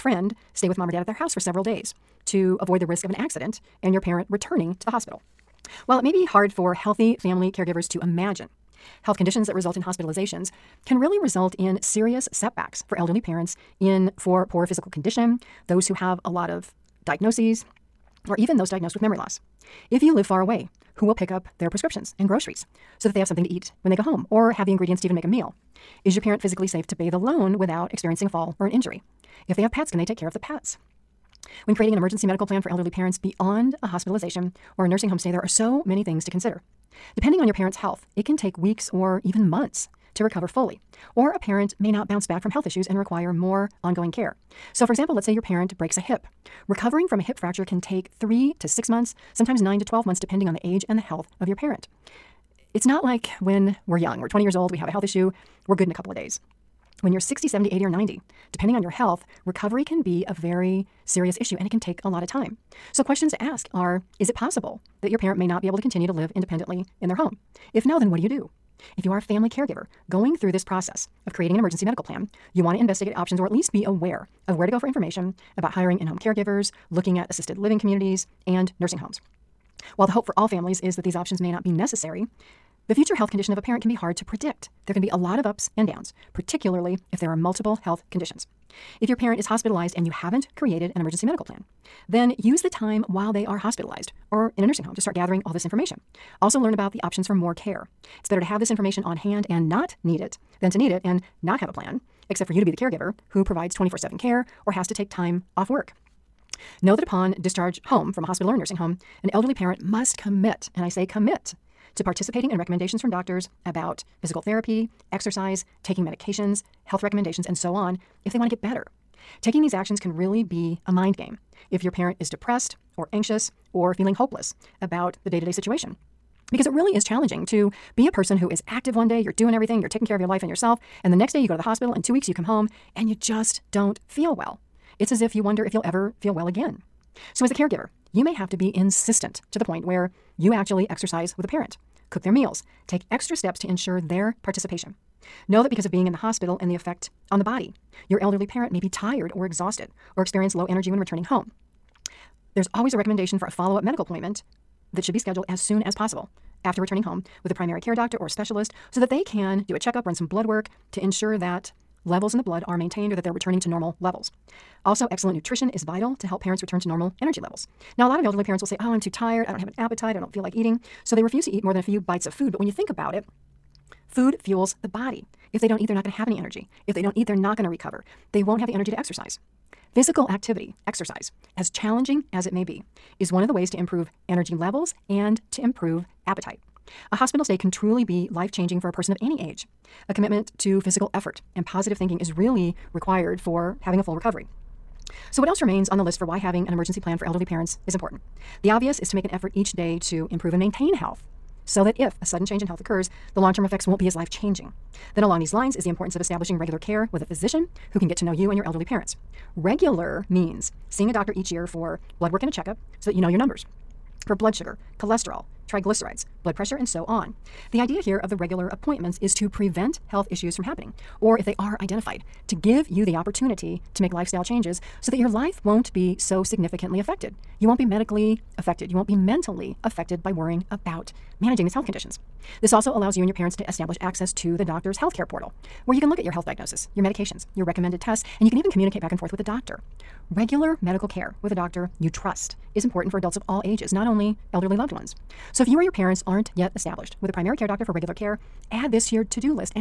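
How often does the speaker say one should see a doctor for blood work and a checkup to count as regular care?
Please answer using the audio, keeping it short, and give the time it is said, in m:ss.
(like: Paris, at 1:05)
each year, at 3:31.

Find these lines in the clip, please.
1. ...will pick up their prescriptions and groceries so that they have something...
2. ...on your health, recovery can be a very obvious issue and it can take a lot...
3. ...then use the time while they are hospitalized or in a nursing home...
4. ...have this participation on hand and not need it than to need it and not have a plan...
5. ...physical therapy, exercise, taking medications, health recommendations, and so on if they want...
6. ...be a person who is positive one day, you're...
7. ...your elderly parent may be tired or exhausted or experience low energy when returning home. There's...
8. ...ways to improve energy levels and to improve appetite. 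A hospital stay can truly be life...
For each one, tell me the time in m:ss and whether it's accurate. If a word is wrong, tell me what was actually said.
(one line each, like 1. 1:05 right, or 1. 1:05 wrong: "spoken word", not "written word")
1. 0:21 right
2. 0:58 wrong: "serious", not "obvious"
3. 1:32 right
4. 1:38 wrong: "information", not "participation"
5. 1:54 right
6. 2:07 wrong: "active", not "positive"
7. 2:28 right
8. 3:03 right.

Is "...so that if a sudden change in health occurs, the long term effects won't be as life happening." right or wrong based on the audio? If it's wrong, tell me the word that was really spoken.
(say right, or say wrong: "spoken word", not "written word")
wrong: "changing", not "happening".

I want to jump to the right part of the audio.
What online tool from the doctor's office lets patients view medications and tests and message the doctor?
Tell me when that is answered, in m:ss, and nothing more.
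3:54.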